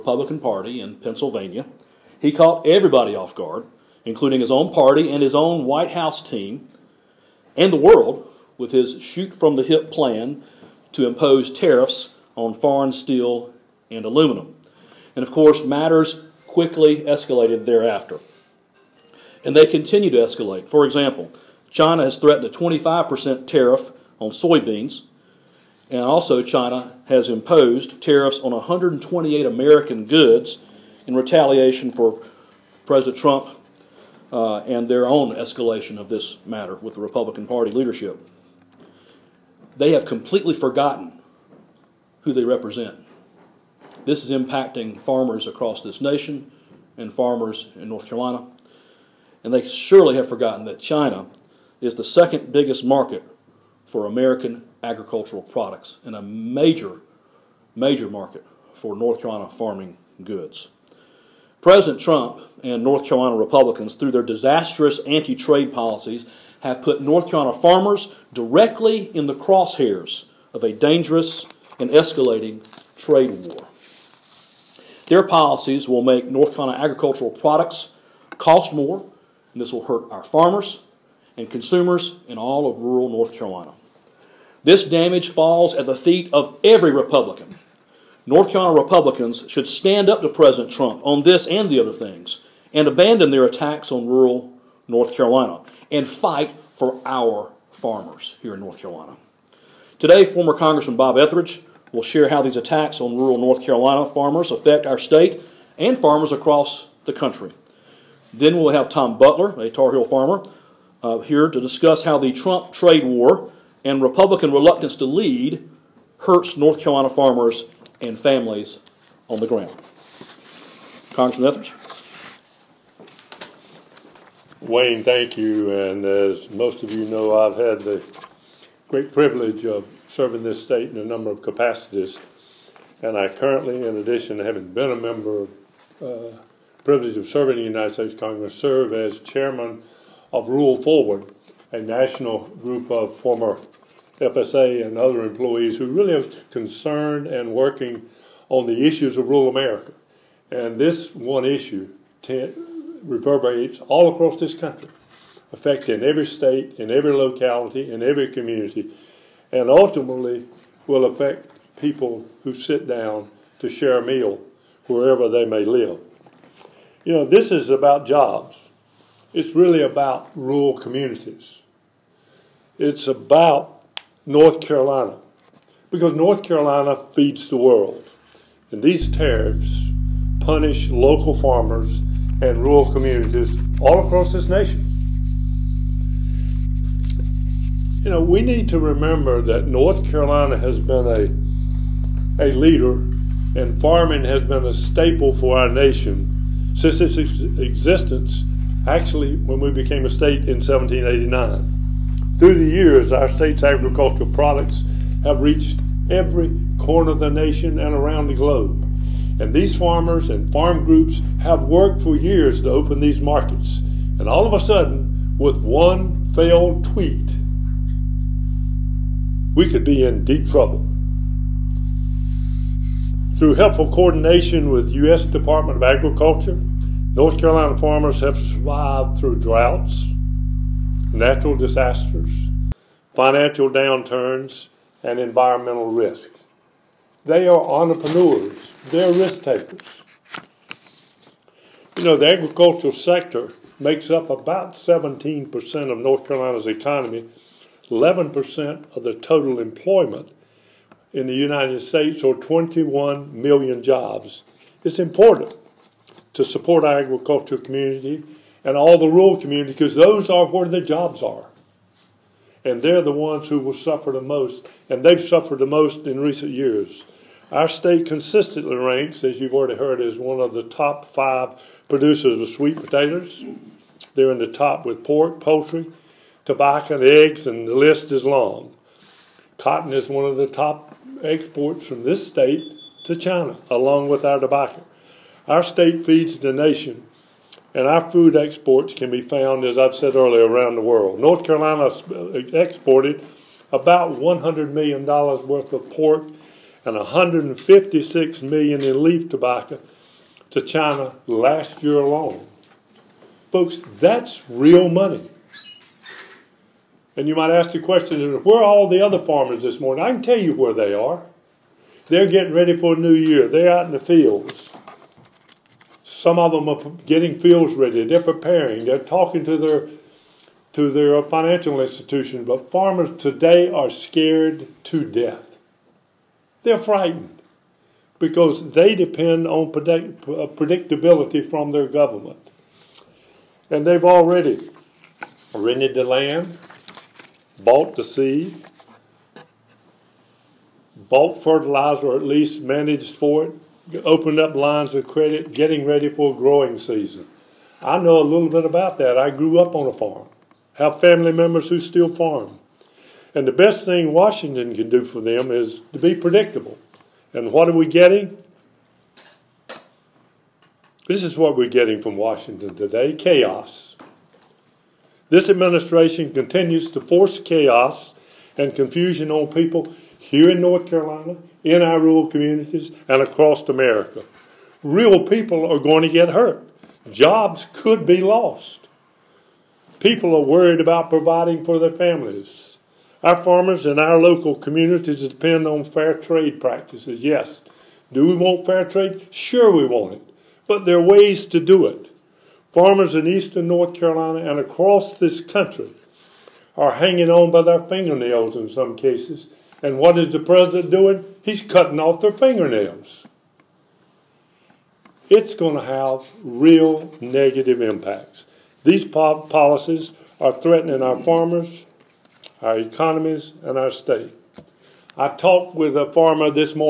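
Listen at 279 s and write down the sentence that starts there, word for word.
Cotton is one of the top exports from this state to China, along with our tobacco.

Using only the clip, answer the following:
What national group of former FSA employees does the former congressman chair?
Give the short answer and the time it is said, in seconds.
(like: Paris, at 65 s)
Rule Forward, at 140 s.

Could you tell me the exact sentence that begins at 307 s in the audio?
And you might ask the question, where are all the other farmers this morning?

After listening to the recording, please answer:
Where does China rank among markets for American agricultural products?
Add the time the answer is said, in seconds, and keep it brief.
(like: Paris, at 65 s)
second biggest, at 52 s.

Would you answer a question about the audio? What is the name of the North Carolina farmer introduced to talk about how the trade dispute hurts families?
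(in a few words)
Tom Butler.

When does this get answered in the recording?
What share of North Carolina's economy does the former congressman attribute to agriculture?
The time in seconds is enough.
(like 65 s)
244 s.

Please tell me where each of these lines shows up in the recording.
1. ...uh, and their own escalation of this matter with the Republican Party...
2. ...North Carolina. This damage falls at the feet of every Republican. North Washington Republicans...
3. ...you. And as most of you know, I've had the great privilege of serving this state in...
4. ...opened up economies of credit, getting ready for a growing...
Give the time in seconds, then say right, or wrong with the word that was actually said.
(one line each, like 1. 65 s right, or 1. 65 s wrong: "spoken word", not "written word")
1. 34 s right
2. 83 s wrong: "Carolina", not "Washington"
3. 125 s right
4. 344 s wrong: "lines", not "economies".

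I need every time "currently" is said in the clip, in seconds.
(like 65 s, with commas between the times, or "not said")
133 s.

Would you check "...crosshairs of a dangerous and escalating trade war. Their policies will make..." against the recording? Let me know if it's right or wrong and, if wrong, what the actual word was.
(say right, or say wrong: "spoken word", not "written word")
right.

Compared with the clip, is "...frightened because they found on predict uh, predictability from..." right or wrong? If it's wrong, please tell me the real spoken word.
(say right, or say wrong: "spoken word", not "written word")
wrong: "depend", not "found".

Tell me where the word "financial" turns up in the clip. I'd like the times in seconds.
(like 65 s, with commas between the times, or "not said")
233 s, 321 s.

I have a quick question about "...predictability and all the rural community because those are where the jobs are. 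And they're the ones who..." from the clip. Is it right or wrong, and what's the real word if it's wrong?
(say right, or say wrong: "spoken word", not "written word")
wrong: "community", not "predictability".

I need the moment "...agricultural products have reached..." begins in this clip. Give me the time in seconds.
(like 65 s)
203 s.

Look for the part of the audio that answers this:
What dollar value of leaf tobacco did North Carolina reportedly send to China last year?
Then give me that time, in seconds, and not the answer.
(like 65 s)
296 s.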